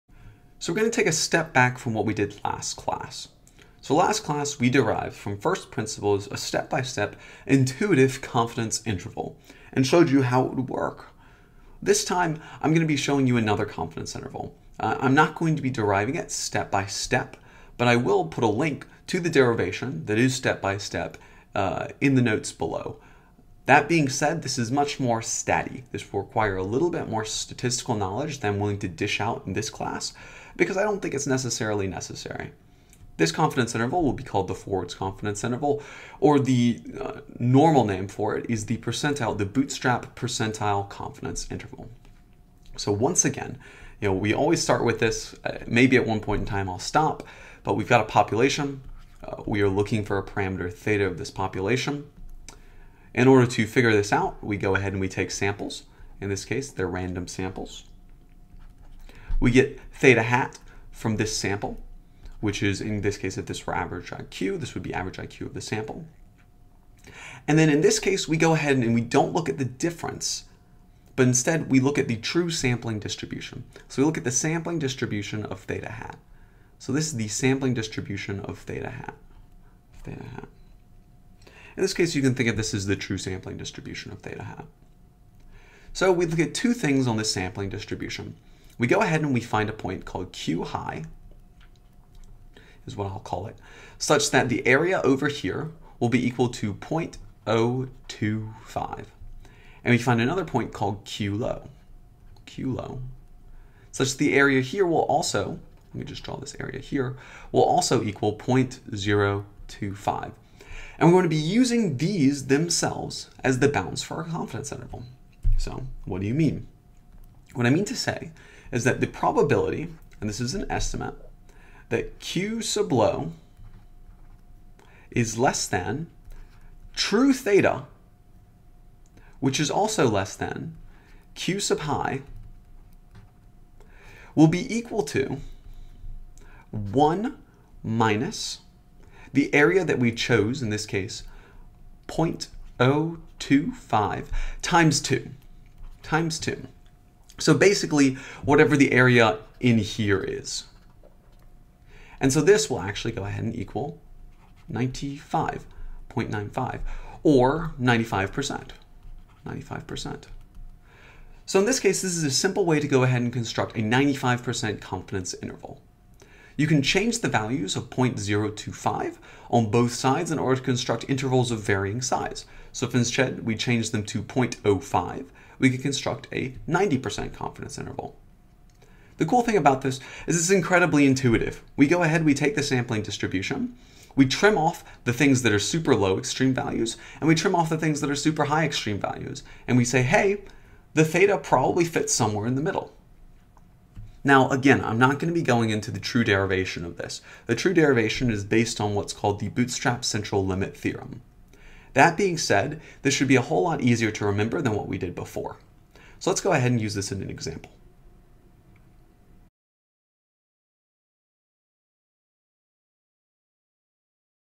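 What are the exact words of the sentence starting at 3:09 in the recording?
And we say, hey, the theta probably fits somewhere in the middle.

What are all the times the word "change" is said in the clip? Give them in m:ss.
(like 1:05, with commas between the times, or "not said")
2:46, 2:53.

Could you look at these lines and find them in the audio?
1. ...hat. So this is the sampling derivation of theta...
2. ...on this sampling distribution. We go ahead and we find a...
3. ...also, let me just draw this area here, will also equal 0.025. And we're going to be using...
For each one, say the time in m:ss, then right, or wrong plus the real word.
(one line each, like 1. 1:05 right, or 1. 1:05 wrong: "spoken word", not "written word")
1. 1:15 wrong: "distribution", not "derivation"
2. 1:27 right
3. 1:45 right.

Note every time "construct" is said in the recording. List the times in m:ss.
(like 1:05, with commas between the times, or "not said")
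2:43, 2:50, 2:55.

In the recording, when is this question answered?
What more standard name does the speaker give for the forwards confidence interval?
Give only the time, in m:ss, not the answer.
0:39.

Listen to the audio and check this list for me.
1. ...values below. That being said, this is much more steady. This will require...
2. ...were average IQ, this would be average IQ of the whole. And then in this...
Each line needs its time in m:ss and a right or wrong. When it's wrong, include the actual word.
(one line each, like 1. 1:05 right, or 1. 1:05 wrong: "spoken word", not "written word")
1. 0:22 wrong: "notes", not "values"
2. 1:03 wrong: "sample", not "whole".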